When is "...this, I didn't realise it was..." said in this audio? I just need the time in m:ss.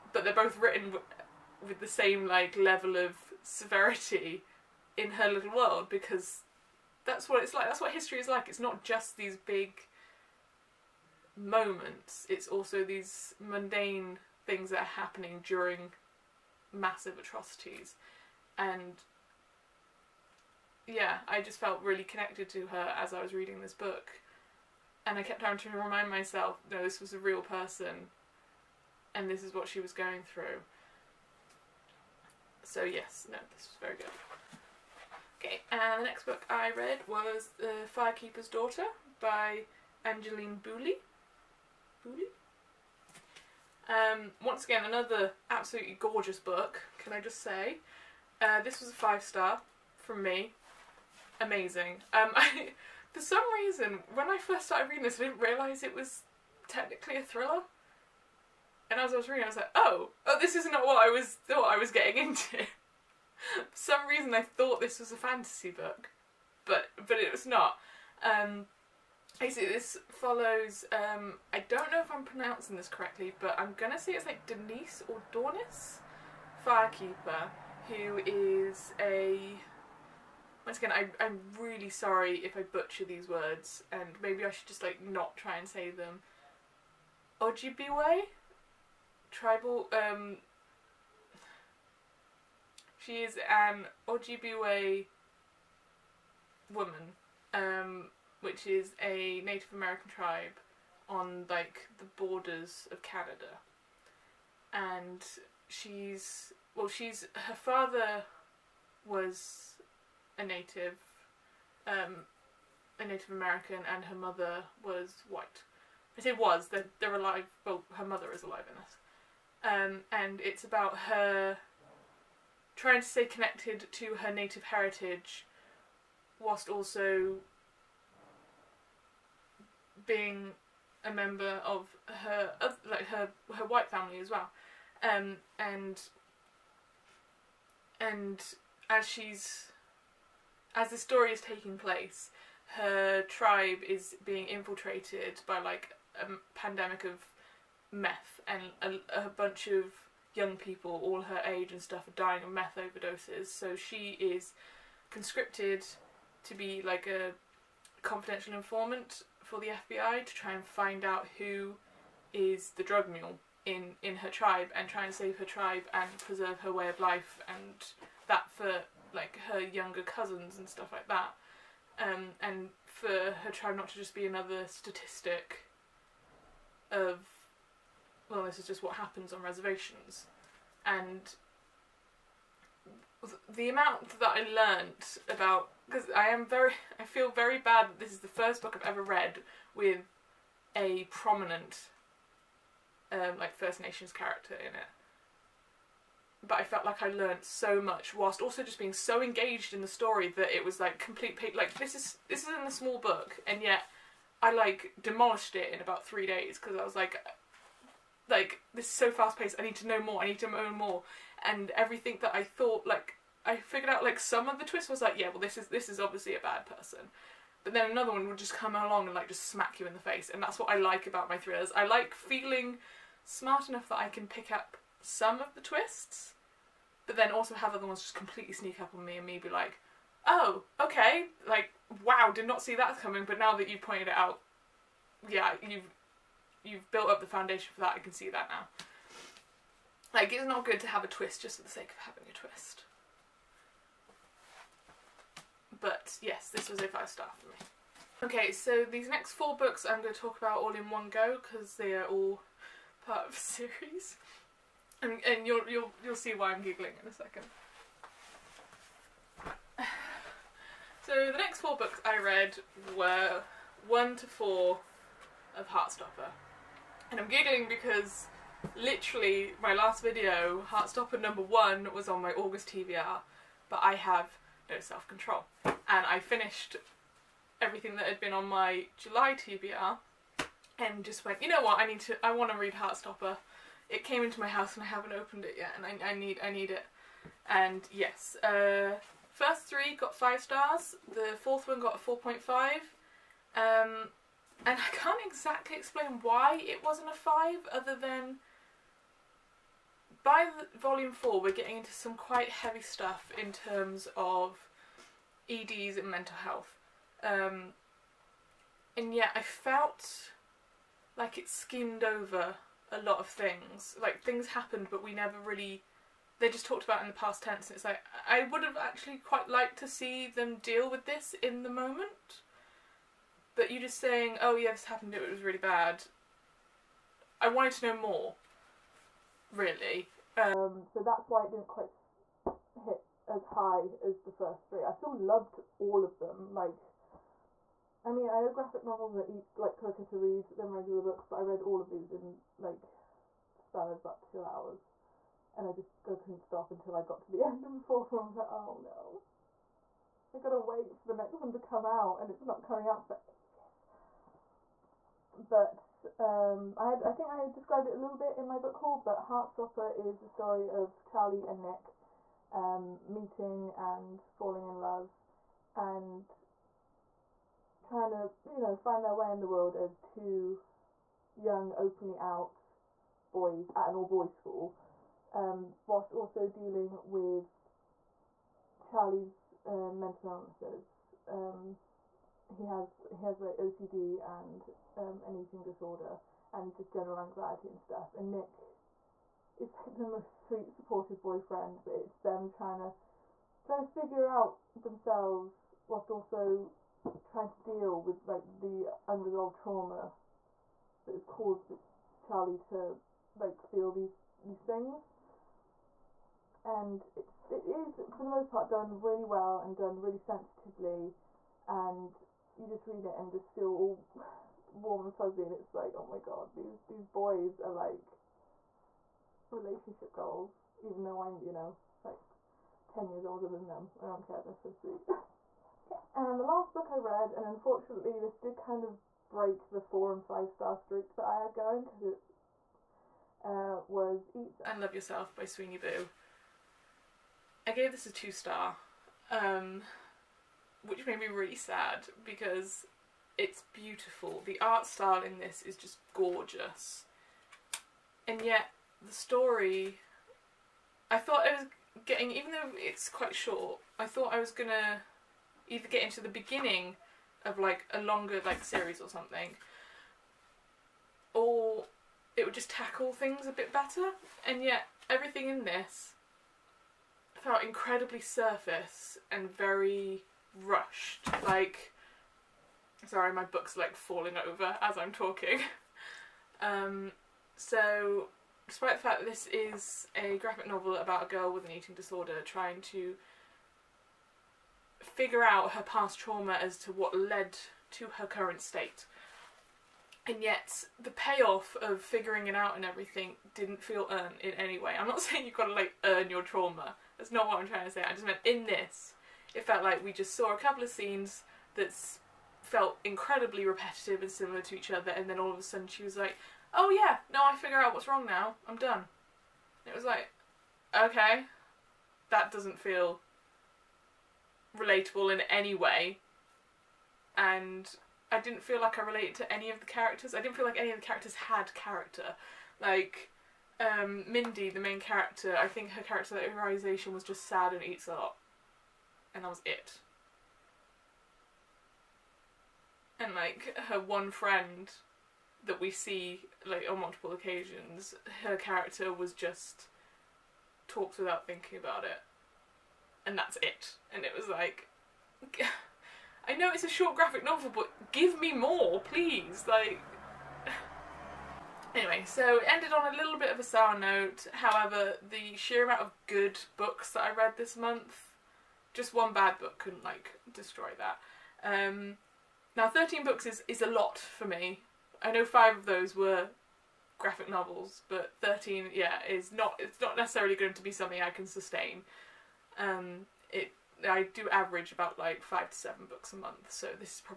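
0:55.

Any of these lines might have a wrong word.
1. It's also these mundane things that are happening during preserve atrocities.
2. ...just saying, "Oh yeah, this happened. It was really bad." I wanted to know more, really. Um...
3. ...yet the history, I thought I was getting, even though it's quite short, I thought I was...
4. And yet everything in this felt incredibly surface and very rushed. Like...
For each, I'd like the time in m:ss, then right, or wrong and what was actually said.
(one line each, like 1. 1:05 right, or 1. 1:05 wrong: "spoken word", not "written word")
1. 0:12 wrong: "massive", not "preserve"
2. 5:23 right
3. 7:28 wrong: "story", not "history"
4. 7:44 right.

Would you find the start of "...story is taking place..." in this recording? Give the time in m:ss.
2:20.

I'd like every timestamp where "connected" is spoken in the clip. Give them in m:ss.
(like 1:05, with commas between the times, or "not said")
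0:22, 2:03.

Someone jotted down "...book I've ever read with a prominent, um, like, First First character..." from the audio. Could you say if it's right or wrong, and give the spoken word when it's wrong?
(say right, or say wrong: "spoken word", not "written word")
wrong: "Nations", not "First".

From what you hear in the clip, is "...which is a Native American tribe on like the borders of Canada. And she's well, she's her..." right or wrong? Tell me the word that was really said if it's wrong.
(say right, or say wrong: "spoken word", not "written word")
right.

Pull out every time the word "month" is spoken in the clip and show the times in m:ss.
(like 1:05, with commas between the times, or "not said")
9:17, 9:36.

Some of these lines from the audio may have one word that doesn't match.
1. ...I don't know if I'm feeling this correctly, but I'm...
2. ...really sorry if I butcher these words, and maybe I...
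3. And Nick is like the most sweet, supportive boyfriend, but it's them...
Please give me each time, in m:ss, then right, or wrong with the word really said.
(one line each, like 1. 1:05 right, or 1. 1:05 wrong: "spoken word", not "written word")
1. 1:11 wrong: "pronouncing", not "feeling"
2. 1:21 right
3. 6:28 right.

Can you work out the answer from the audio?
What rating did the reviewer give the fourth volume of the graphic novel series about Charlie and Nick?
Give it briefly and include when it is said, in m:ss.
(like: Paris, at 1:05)
4.5, at 4:52.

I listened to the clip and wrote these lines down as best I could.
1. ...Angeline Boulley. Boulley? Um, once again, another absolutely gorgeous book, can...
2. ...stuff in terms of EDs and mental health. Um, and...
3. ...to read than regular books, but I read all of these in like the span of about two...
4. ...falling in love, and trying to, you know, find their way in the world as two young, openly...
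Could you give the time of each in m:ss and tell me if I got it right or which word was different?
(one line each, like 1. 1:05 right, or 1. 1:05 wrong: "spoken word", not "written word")
1. 0:40 right
2. 5:02 right
3. 5:40 right
4. 6:04 right.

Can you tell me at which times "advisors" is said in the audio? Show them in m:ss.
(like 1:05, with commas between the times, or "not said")
not said.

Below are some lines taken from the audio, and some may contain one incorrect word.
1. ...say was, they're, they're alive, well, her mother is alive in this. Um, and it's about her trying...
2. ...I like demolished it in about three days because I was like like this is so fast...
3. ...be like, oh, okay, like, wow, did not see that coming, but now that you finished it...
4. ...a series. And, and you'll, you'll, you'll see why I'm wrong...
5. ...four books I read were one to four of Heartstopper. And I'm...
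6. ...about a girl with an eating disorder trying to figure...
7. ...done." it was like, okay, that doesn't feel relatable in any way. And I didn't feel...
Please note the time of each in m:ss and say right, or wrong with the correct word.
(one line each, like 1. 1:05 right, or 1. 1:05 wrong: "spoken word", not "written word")
1. 1:56 right
2. 3:24 right
3. 3:49 wrong: "pointed", not "finished"
4. 4:13 wrong: "giggling", not "wrong"
5. 4:21 right
6. 8:00 right
7. 8:28 right.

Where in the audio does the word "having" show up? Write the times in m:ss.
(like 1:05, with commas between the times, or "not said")
0:25, 4:02.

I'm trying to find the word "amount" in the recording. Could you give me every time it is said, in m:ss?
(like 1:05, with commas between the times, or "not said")
3:03, 9:15.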